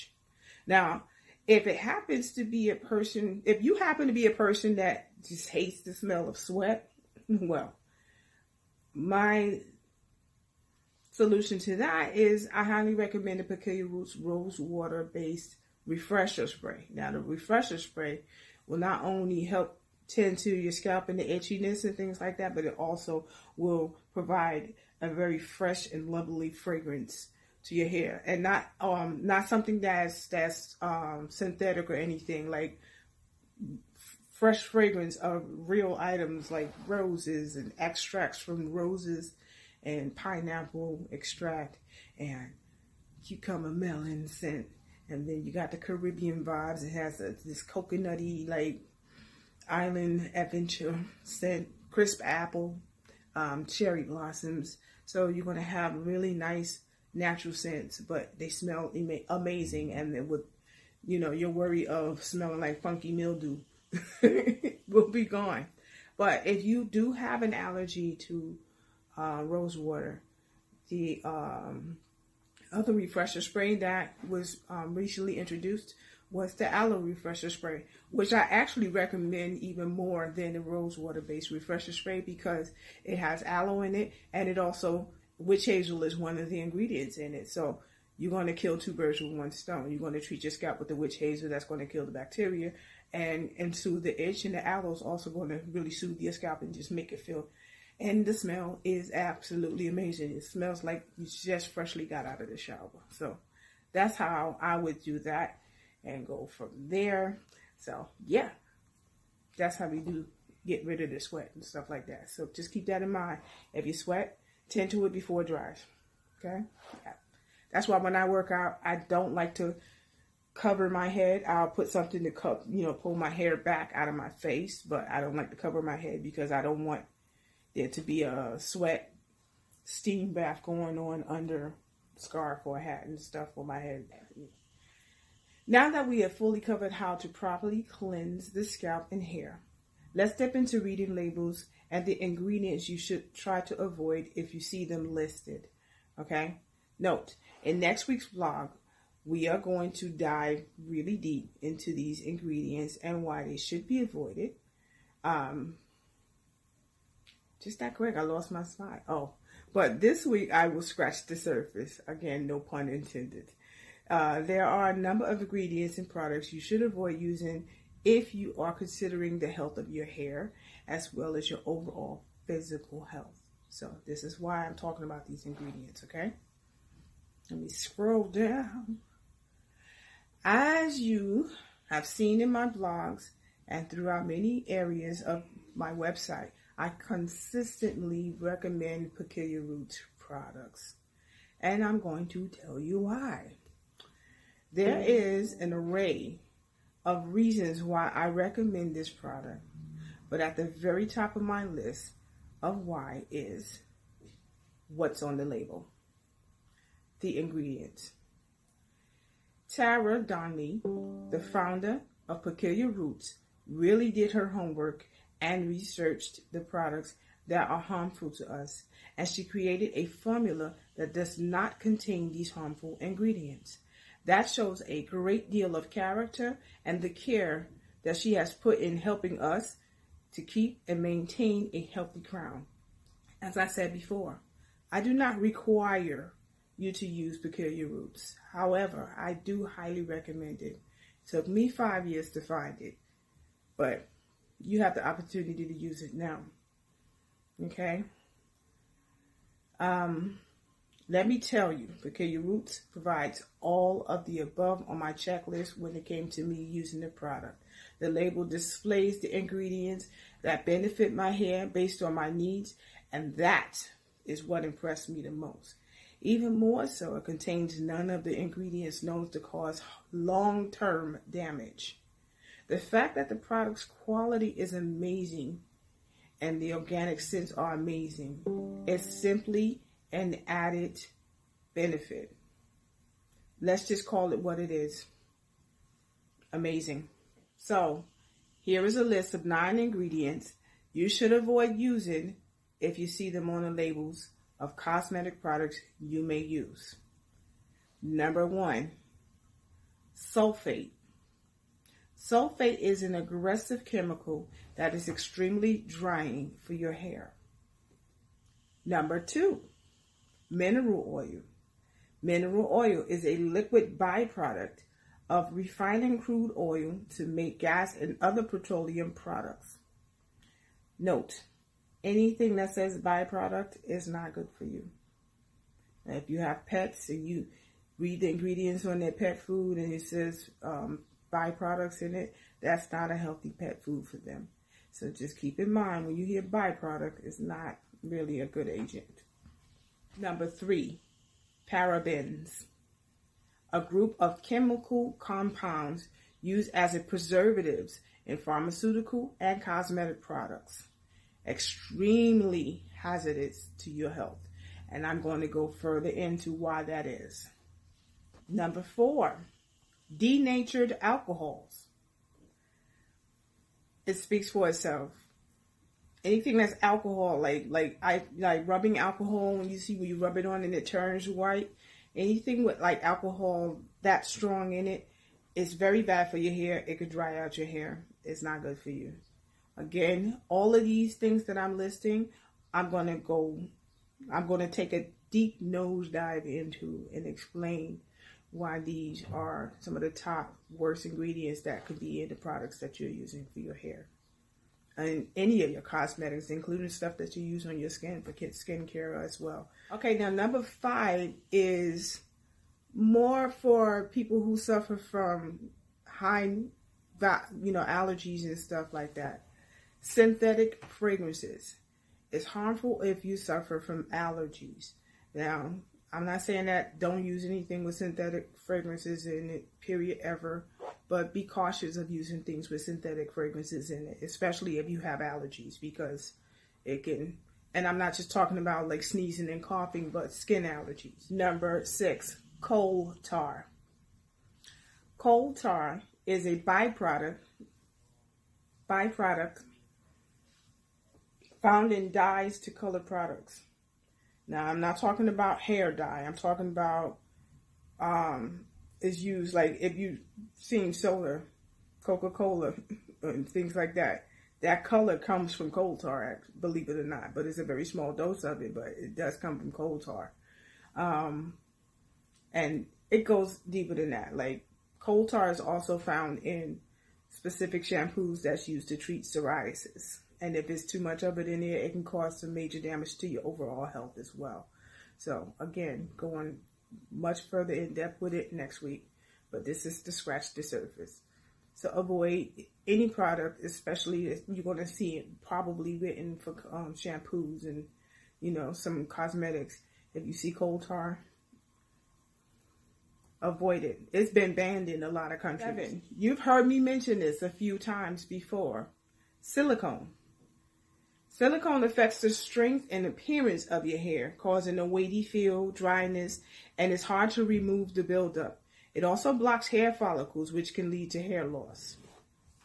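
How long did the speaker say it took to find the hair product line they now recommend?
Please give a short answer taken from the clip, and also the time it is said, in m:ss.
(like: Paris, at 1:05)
5 years, at 4:01.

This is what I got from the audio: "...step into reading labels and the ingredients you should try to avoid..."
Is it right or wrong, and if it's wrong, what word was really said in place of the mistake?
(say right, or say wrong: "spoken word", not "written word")
right.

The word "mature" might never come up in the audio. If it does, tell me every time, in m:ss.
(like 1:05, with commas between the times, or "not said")
not said.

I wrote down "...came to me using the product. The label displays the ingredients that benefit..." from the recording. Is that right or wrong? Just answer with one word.
right.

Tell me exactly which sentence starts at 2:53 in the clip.
So, this is why I'm talking about these ingredients, okay?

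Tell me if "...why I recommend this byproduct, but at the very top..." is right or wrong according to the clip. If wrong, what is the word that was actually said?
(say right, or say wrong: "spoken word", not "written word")
wrong: "product", not "byproduct".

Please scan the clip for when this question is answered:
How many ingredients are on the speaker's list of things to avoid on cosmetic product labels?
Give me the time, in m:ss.
4:49.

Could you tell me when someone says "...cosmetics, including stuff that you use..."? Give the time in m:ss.
6:35.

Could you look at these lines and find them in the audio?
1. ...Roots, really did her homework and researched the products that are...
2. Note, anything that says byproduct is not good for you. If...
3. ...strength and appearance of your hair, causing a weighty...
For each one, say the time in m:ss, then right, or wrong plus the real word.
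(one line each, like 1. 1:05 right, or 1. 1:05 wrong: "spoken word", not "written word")
1. 3:32 right
2. 5:20 right
3. 8:22 right.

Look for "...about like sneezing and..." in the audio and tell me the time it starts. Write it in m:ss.
7:08.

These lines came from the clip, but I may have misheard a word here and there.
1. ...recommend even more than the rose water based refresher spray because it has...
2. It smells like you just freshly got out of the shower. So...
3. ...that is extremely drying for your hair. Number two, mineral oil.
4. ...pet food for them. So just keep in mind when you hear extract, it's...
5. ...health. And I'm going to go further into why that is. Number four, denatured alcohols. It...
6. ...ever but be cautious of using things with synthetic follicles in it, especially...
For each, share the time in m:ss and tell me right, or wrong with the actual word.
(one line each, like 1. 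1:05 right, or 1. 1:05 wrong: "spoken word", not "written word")
1. 1:18 right
2. 1:40 right
3. 5:04 right
4. 5:33 wrong: "byproduct", not "extract"
5. 5:54 right
6. 7:00 wrong: "fragrances", not "follicles".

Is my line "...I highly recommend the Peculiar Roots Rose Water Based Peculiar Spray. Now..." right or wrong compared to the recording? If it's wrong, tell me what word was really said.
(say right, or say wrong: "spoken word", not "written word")
wrong: "Refresher", not "Peculiar".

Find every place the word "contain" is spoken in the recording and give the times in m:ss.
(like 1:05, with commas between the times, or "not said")
3:41, 4:27.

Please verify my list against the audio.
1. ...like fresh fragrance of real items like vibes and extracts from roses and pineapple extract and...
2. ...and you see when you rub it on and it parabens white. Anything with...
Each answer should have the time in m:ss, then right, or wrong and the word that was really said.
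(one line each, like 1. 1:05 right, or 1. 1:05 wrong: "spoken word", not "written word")
1. 0:32 wrong: "roses", not "vibes"
2. 6:09 wrong: "turns", not "parabens".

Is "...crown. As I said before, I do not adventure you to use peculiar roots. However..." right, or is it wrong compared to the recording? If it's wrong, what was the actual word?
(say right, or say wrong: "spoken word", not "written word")
wrong: "require", not "adventure".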